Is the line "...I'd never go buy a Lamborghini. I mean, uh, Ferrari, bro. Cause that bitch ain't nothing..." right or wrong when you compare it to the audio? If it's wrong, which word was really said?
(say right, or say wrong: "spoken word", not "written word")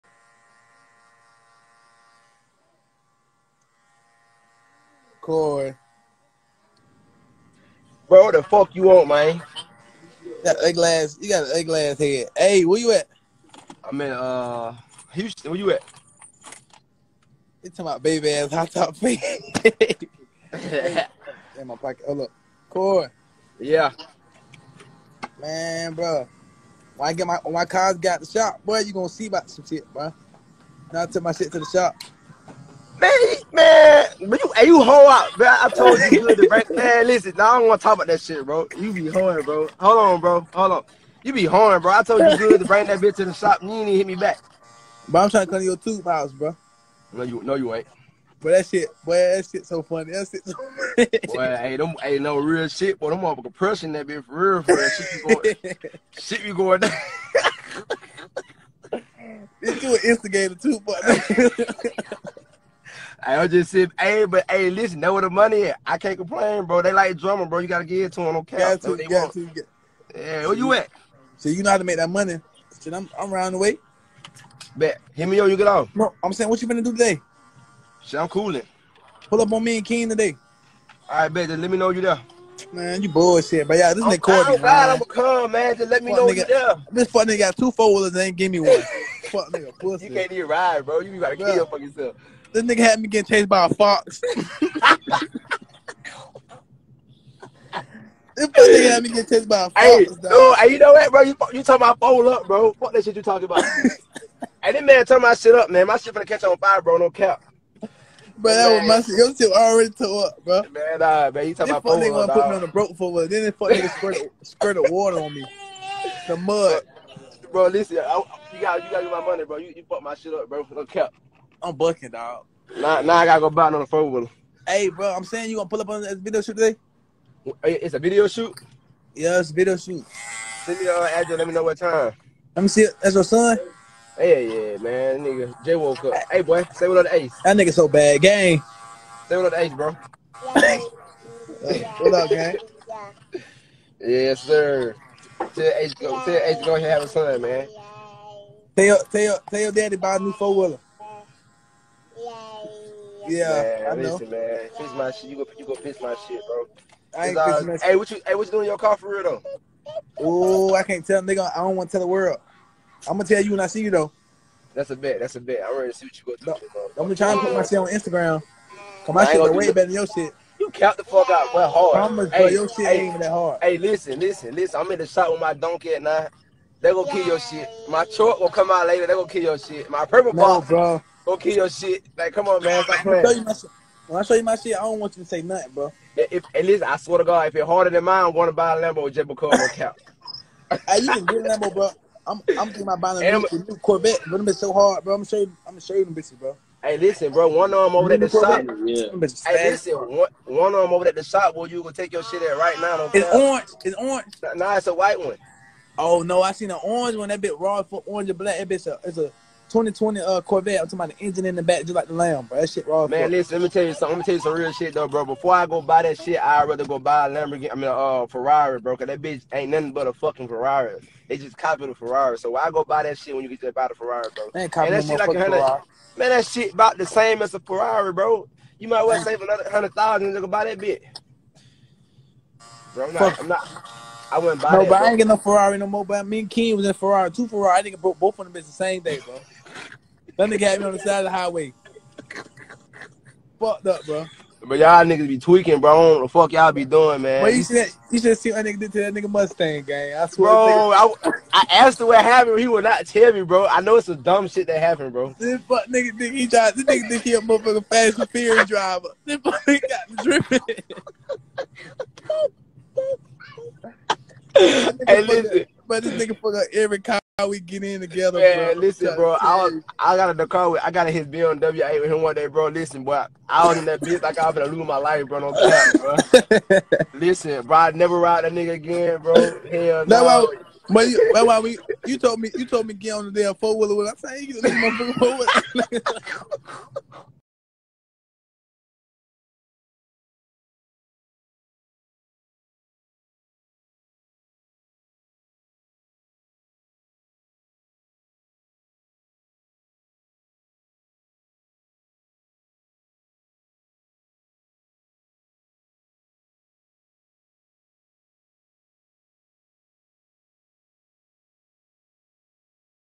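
wrong: "rather", not "never".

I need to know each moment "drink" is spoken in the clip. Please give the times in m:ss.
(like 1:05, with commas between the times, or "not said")
not said.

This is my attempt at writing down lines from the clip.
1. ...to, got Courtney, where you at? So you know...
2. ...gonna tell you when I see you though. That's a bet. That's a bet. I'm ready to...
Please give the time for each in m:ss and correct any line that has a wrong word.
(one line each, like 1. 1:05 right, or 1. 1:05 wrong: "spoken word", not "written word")
1. 1:09 wrong: "Yeah", not "Courtney"
2. 2:43 right.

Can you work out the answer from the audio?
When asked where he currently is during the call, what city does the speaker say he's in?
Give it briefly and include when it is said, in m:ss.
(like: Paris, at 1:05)
Houston, at 0:15.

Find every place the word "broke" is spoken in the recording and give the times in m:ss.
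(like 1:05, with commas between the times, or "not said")
1:52.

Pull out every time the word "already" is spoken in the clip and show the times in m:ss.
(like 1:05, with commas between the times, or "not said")
1:49.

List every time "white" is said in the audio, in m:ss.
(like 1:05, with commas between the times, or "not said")
3:24.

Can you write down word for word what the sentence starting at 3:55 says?
I ain't get no Ferrari no more.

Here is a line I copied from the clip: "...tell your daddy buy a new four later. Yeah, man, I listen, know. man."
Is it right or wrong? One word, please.
wrong.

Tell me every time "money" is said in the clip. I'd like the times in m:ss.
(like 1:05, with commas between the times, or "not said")
1:05, 1:12, 1:59.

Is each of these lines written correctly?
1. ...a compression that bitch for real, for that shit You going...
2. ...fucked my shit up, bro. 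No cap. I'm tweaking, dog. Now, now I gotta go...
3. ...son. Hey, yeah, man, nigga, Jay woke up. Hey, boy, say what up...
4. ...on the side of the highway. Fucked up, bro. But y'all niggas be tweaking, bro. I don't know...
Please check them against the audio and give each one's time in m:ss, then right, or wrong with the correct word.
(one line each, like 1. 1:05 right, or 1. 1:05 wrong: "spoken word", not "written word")
1. 0:53 right
2. 1:59 wrong: "bucking", not "tweaking"
3. 2:13 right
4. 4:00 right.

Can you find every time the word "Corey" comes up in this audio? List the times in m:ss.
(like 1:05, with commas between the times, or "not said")
0:05, 0:22.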